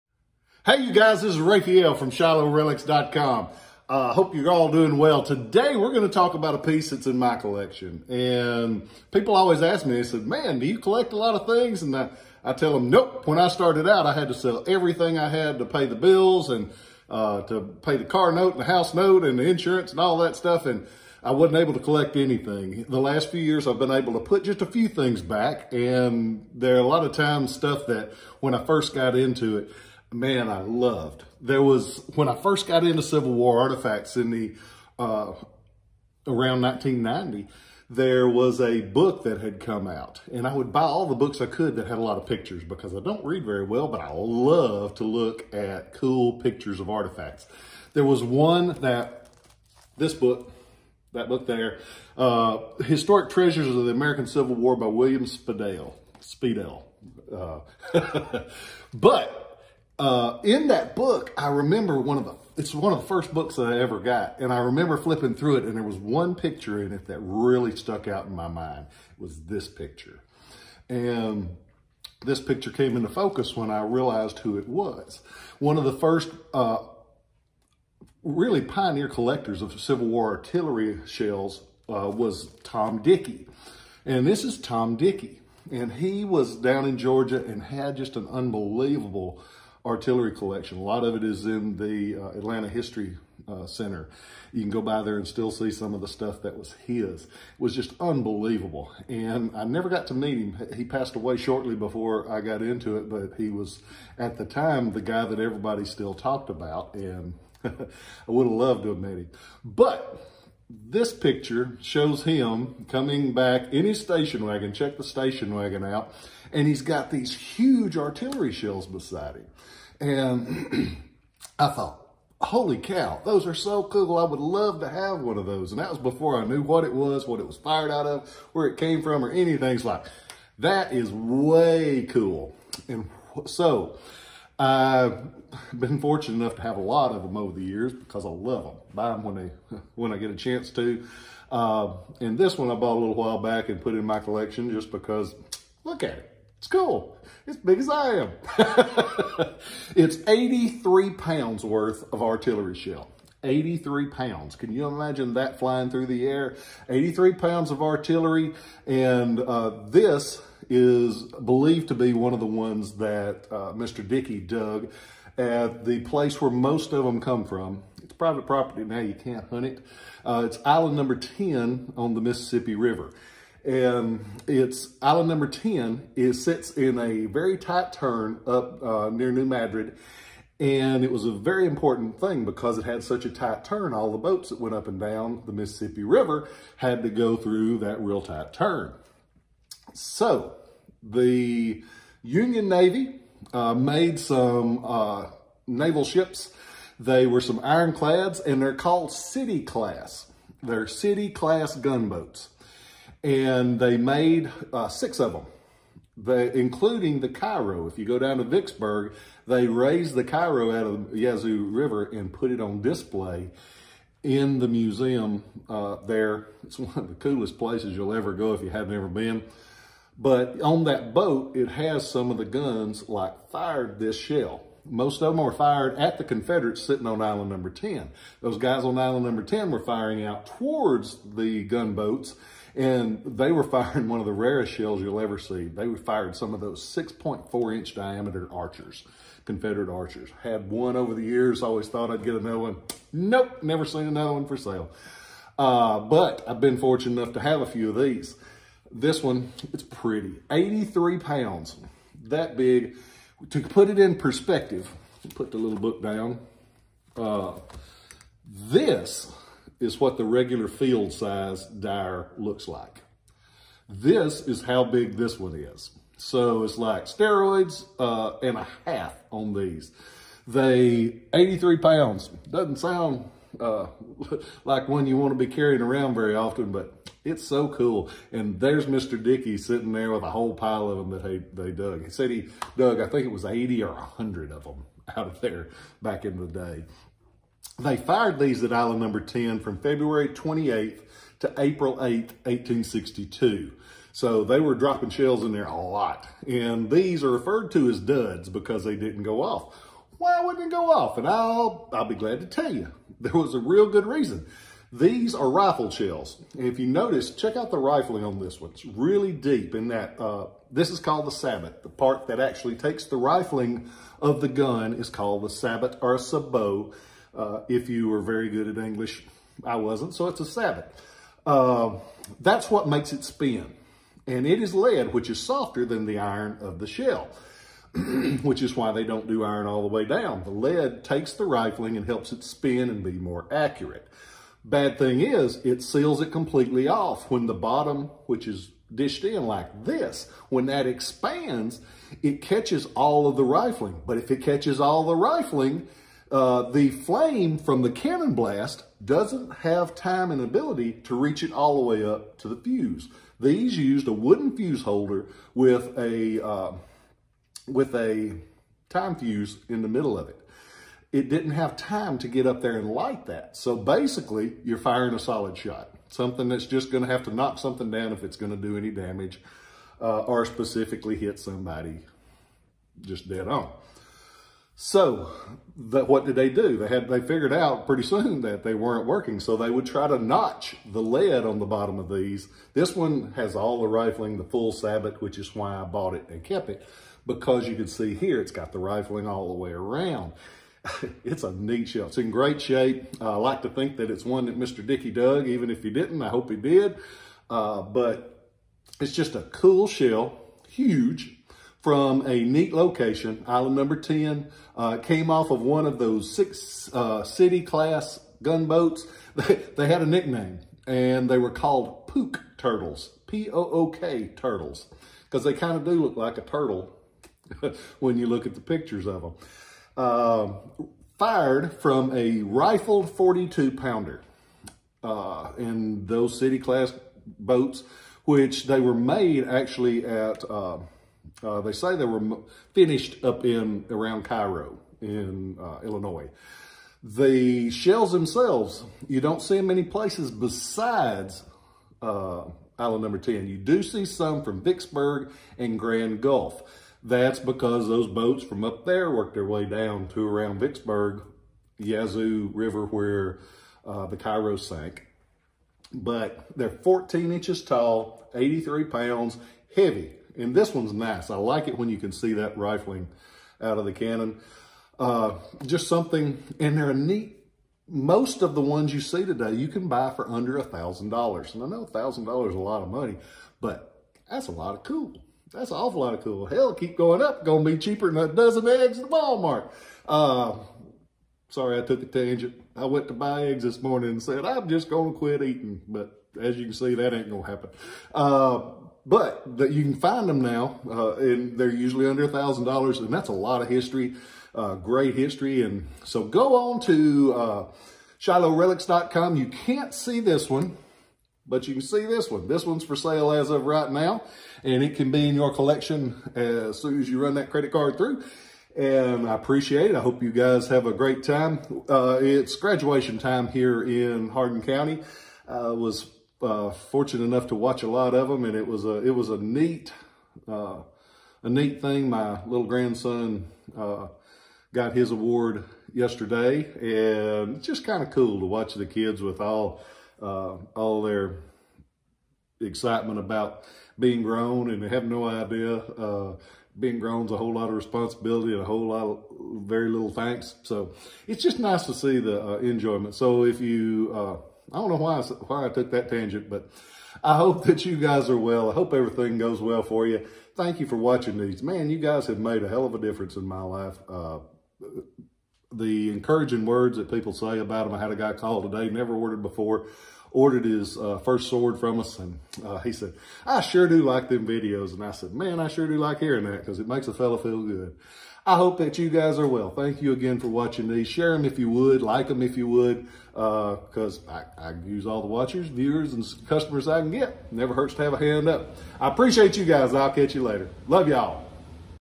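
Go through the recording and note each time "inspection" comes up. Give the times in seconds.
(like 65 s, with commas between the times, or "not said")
not said.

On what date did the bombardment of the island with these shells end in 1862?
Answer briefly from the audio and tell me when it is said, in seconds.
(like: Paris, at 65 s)
April 8th, at 291 s.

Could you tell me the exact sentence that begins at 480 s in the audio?
Uh, sorry, I took a tangent.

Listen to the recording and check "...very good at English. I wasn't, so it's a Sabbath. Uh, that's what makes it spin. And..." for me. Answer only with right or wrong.
right.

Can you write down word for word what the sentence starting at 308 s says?
It's really deep in that, uh, this is called the sabot.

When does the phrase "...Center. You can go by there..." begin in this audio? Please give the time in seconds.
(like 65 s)
93 s.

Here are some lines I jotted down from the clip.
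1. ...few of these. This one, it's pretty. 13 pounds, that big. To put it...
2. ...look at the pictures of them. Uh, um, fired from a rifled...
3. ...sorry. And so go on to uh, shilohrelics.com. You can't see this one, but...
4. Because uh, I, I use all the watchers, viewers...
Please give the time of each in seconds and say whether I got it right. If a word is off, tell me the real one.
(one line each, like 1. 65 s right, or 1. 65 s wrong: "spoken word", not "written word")
1. 247 s wrong: "83", not "13"
2. 418 s right
3. 495 s wrong: "history", not "sorry"
4. 573 s right.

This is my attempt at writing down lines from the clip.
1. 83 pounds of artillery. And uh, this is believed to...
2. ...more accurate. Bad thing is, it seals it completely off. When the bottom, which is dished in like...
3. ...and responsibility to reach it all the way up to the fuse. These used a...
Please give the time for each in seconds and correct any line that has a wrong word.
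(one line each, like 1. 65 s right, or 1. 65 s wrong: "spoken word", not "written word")
1. 156 s right
2. 333 s right
3. 350 s wrong: "ability", not "responsibility".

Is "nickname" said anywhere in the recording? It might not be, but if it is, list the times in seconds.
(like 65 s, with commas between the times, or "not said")
410 s.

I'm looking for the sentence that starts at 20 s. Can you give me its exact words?
And I wasn't able to collect anything.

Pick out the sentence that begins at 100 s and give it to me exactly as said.
He passed away shortly before I got into it, but he was, at the time, the guy that everybody still talked about.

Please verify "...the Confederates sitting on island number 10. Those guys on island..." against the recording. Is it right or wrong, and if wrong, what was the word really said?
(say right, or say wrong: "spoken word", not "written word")
right.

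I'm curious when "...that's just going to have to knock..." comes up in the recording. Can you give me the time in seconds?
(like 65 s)
366 s.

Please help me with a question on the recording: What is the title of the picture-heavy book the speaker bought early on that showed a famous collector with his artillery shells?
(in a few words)
Historic Treasures of the American Civil War.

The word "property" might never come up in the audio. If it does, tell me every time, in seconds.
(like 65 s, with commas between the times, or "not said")
168 s.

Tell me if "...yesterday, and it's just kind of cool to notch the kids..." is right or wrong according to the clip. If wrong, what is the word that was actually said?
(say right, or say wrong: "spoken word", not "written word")
wrong: "watch", not "notch".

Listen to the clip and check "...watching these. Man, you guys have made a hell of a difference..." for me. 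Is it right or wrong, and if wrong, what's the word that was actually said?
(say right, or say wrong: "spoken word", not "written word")
right.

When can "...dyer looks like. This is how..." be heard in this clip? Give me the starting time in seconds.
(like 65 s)
261 s.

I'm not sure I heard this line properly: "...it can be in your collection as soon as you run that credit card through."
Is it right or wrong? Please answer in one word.
right.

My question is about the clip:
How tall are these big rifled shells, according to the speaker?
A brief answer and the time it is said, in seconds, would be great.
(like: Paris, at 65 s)
14 inches, at 456 s.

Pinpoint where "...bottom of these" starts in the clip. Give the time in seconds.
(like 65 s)
381 s.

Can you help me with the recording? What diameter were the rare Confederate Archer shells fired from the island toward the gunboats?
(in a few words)
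6.4 inch.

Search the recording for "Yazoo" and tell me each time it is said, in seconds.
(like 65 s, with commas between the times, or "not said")
211 s, 451 s.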